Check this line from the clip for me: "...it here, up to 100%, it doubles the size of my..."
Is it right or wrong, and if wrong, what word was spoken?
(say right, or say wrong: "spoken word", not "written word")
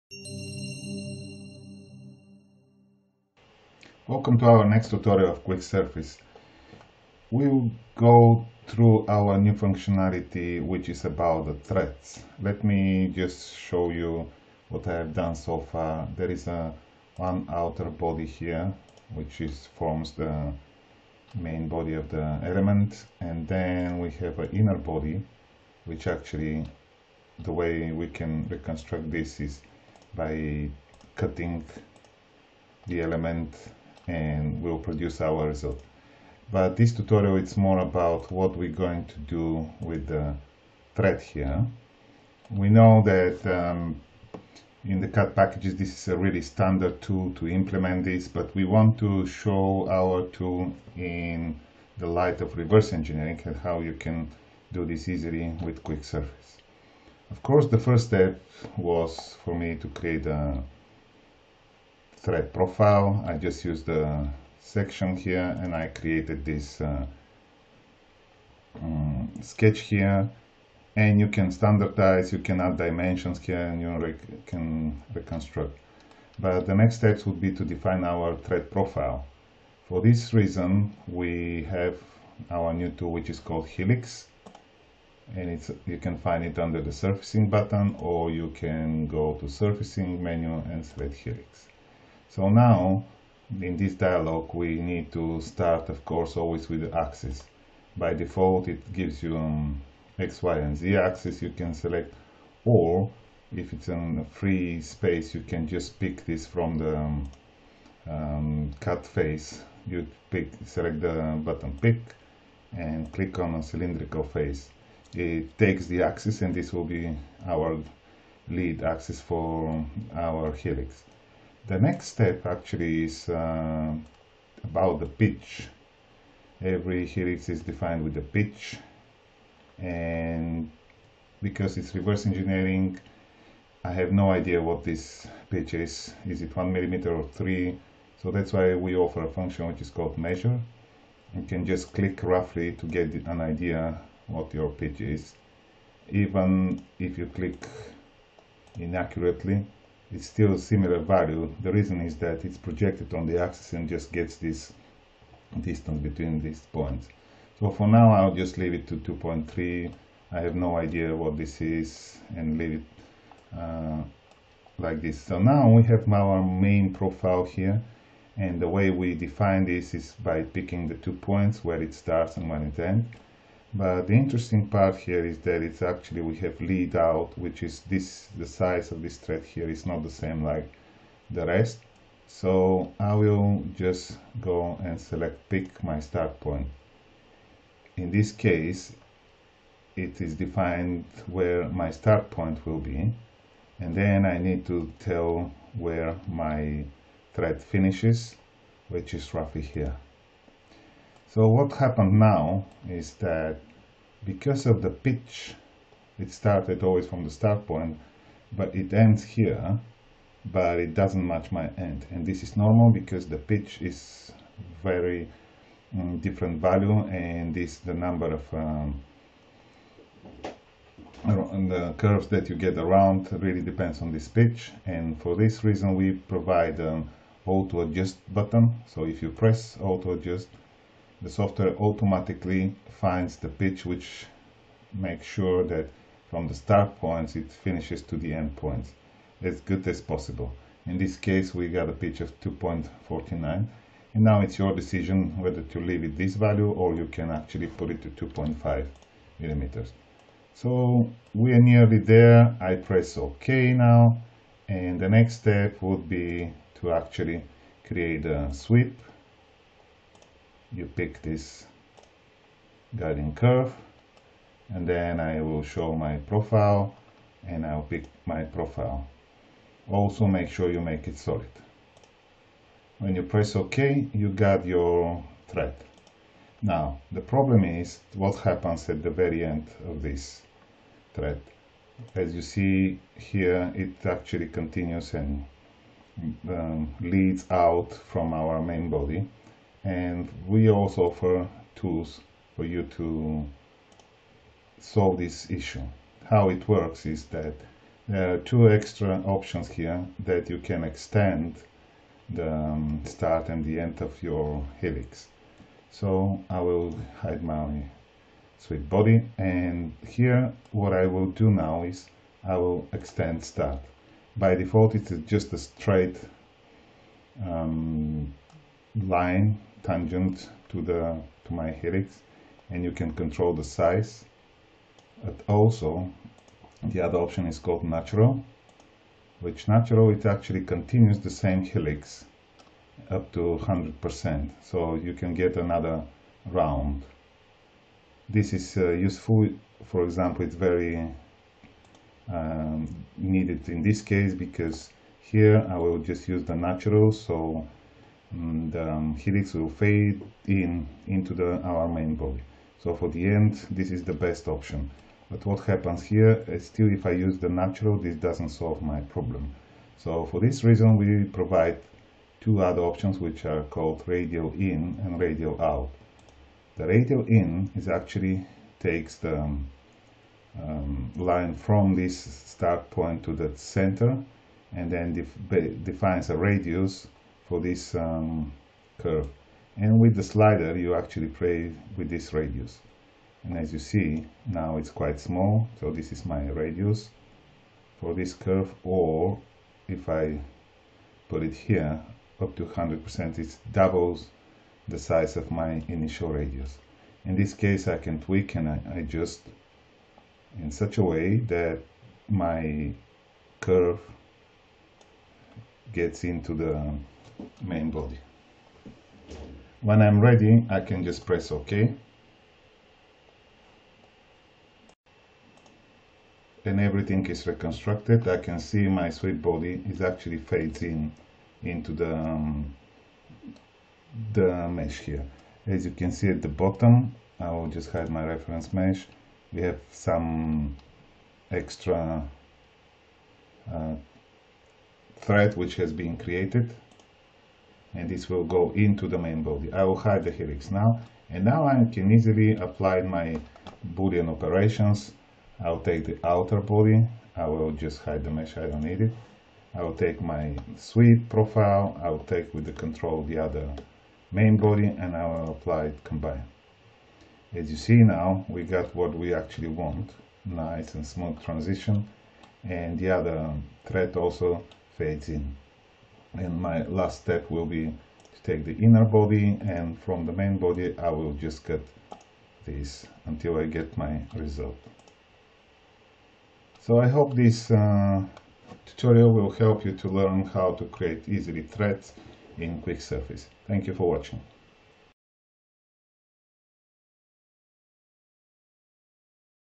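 right.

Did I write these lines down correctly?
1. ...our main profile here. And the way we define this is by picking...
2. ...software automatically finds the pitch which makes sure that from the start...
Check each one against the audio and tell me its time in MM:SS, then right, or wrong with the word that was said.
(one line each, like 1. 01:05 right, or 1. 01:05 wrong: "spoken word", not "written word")
1. 02:46 right
2. 03:51 right.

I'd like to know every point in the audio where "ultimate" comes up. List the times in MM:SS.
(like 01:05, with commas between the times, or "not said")
not said.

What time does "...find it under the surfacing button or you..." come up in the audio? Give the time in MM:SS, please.
01:26.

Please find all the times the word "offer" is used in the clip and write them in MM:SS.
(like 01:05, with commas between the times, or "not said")
02:18, 04:51.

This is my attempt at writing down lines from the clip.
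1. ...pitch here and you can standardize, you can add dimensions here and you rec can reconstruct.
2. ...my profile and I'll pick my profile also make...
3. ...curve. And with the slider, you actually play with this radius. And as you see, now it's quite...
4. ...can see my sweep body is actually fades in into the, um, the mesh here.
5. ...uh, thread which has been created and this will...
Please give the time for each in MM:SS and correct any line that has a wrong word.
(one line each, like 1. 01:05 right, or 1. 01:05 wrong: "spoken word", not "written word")
1. 01:09 wrong: "sketch", not "pitch"
2. 04:25 right
3. 06:18 right
4. 06:58 right
5. 07:13 right.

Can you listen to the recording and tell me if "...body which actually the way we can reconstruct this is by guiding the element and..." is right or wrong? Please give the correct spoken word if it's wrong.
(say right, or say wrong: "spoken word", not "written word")
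wrong: "cutting", not "guiding".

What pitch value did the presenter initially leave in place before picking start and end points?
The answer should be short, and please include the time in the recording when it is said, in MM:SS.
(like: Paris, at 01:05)
2.3, at 02:38.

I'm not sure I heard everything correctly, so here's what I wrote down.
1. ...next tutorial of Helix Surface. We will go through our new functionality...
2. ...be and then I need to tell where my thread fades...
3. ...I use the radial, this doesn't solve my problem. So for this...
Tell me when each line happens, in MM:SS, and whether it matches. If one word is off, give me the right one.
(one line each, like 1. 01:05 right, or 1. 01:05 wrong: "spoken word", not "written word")
1. 00:04 wrong: "Quick", not "Helix"
2. 03:12 wrong: "finishes", not "fades"
3. 05:57 wrong: "natural", not "radial".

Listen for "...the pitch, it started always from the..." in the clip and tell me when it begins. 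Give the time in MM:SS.
03:24.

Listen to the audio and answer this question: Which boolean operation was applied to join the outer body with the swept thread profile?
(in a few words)
combined.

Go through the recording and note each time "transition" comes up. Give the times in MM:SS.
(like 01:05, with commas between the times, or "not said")
07:41.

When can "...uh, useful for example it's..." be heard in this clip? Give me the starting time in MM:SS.
05:38.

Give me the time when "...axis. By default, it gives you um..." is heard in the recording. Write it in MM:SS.
01:36.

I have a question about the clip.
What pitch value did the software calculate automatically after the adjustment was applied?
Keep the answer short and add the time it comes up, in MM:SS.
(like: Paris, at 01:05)
2.49, at 04:02.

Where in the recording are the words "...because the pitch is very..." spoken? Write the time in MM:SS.
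03:32.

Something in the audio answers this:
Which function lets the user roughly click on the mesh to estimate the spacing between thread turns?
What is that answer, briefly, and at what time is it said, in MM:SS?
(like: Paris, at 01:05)
measure, at 02:20.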